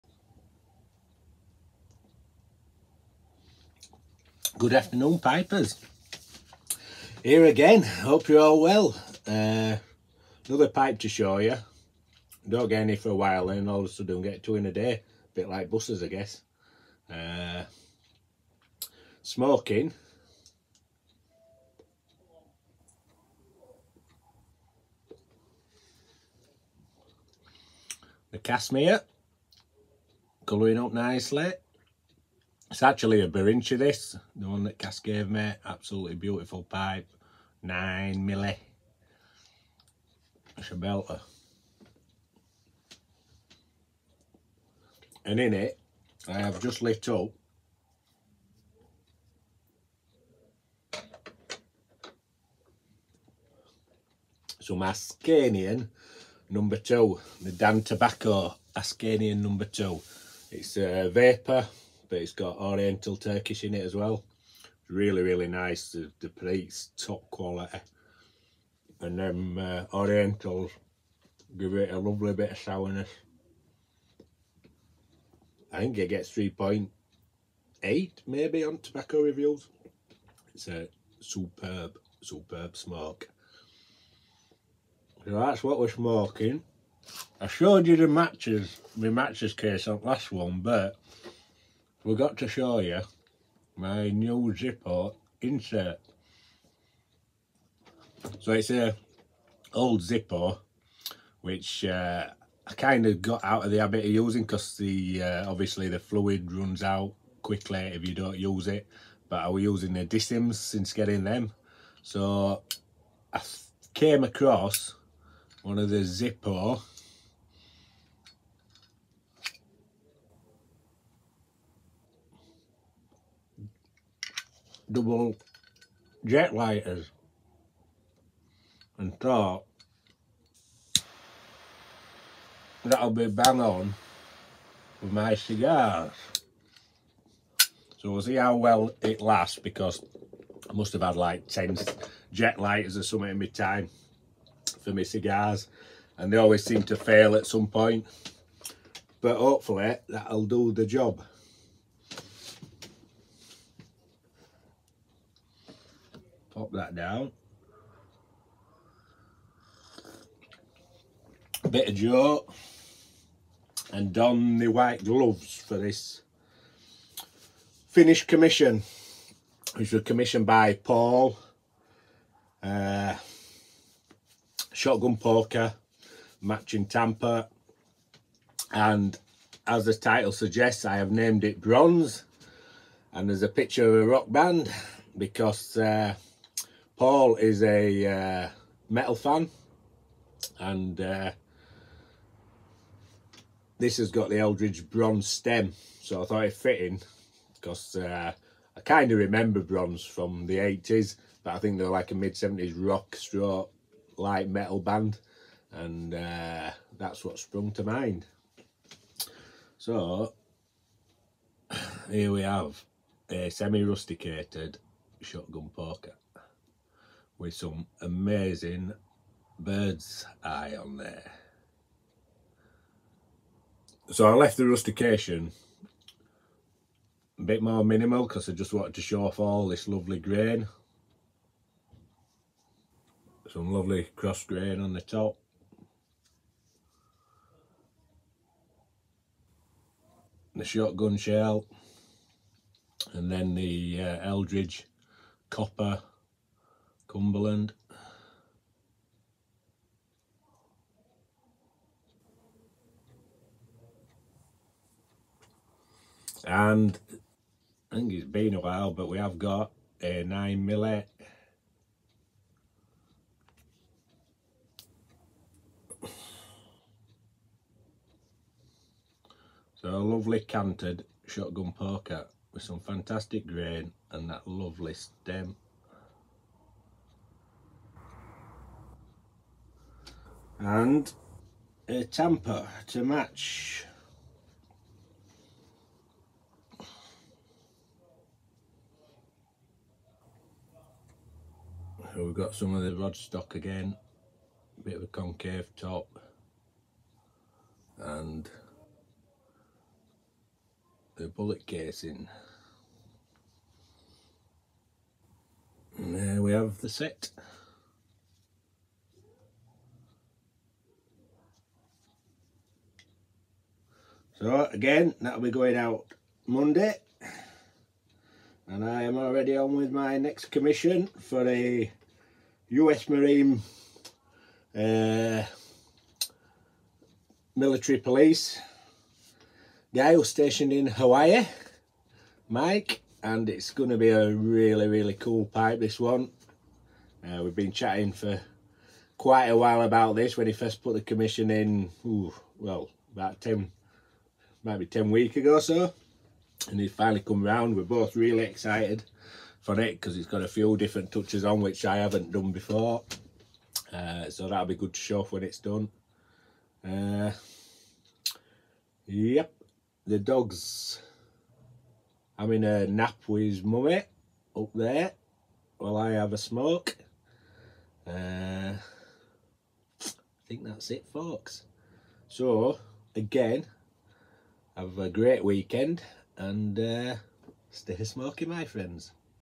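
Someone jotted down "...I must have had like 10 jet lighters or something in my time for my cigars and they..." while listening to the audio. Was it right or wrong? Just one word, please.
right.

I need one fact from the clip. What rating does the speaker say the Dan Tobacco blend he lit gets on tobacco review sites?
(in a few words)
3.8.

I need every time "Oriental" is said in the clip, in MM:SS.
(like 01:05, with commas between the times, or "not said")
01:02, 01:09.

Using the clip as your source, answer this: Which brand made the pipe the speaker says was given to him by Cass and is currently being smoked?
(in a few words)
Berinchi.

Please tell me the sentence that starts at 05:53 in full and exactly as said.
Uh, so that'll be good to show off when it's done.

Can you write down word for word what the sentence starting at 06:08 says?
Uh, I think that's it, folks.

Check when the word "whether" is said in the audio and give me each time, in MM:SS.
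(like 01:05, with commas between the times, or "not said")
not said.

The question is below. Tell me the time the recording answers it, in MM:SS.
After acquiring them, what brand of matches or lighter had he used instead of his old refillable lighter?
01:50.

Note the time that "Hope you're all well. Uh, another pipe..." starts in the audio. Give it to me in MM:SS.
00:07.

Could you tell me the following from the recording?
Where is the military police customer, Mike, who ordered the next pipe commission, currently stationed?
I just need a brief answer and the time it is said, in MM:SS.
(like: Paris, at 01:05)
Hawaii, at 05:30.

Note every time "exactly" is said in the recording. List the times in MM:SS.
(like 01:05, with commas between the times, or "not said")
not said.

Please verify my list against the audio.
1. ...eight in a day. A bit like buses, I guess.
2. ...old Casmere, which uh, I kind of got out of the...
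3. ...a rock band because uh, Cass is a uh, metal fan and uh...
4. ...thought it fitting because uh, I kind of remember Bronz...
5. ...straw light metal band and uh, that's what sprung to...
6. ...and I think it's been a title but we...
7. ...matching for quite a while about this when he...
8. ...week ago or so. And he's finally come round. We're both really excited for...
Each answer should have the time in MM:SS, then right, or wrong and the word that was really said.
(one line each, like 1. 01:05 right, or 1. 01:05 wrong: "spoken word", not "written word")
1. 00:14 wrong: "two", not "eight"
2. 01:39 wrong: "Zippo", not "Casmere"
3. 03:04 wrong: "Paul", not "Cass"
4. 03:16 right
5. 03:23 right
6. 04:16 wrong: "while", not "title"
7. 05:37 wrong: "chatting", not "matching"
8. 05:45 right.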